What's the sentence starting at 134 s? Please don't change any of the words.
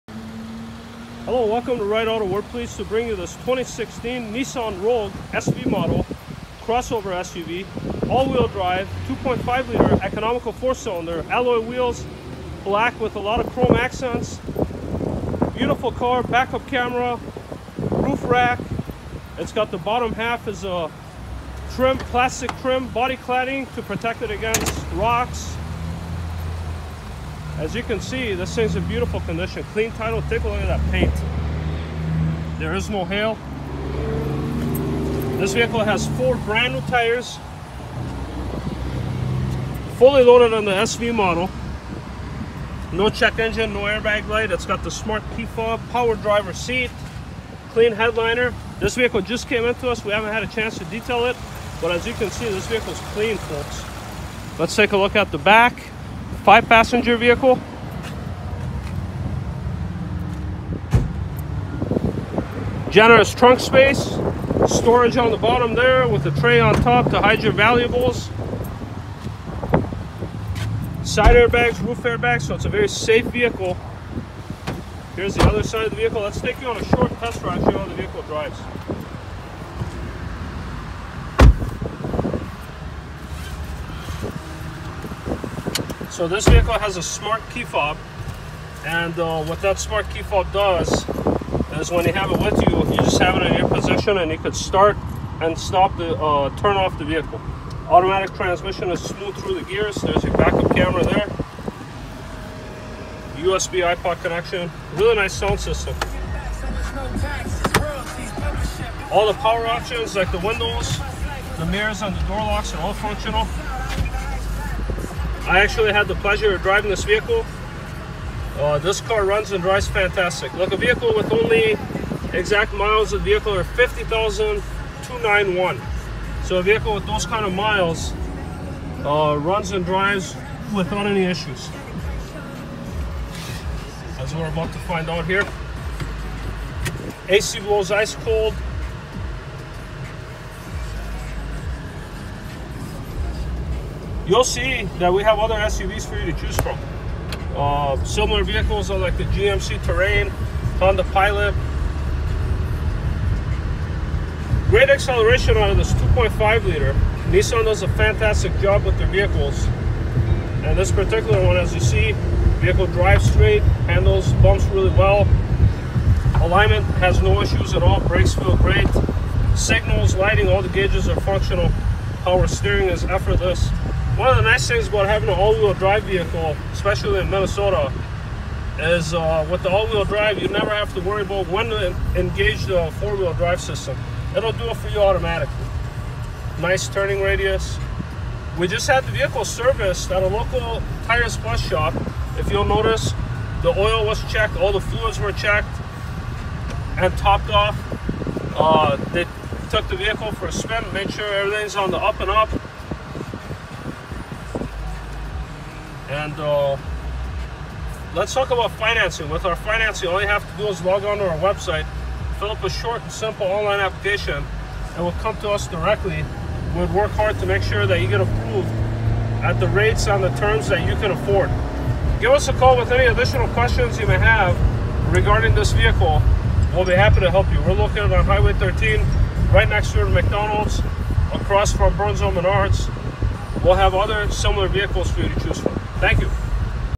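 As we're about to find out here.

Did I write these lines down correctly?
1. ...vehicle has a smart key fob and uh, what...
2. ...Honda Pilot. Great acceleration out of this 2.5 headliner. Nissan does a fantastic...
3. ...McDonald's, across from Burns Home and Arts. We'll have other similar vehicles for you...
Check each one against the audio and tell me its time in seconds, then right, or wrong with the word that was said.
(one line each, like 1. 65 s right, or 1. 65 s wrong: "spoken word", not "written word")
1. 86 s right
2. 150 s wrong: "liter", not "headliner"
3. 230 s right.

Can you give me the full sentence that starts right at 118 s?
Uh, this car runs and drives fantastic.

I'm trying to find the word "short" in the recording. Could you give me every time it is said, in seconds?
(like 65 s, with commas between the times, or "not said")
76 s, 212 s.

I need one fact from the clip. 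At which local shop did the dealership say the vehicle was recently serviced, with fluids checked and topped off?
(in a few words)
Tires Plus.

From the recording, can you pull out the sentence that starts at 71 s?
Side airbags, roof airbags, so it's a very safe vehicle.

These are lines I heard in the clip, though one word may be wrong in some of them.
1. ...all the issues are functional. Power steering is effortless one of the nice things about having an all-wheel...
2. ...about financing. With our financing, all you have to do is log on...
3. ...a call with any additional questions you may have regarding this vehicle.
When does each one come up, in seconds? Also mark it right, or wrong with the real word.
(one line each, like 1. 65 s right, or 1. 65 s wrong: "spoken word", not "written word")
1. 170 s wrong: "gauges", not "issues"
2. 208 s right
3. 222 s right.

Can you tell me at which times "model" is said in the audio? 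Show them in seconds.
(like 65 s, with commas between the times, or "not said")
5 s, 41 s.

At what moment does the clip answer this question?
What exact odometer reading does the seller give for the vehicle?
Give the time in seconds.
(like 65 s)
123 s.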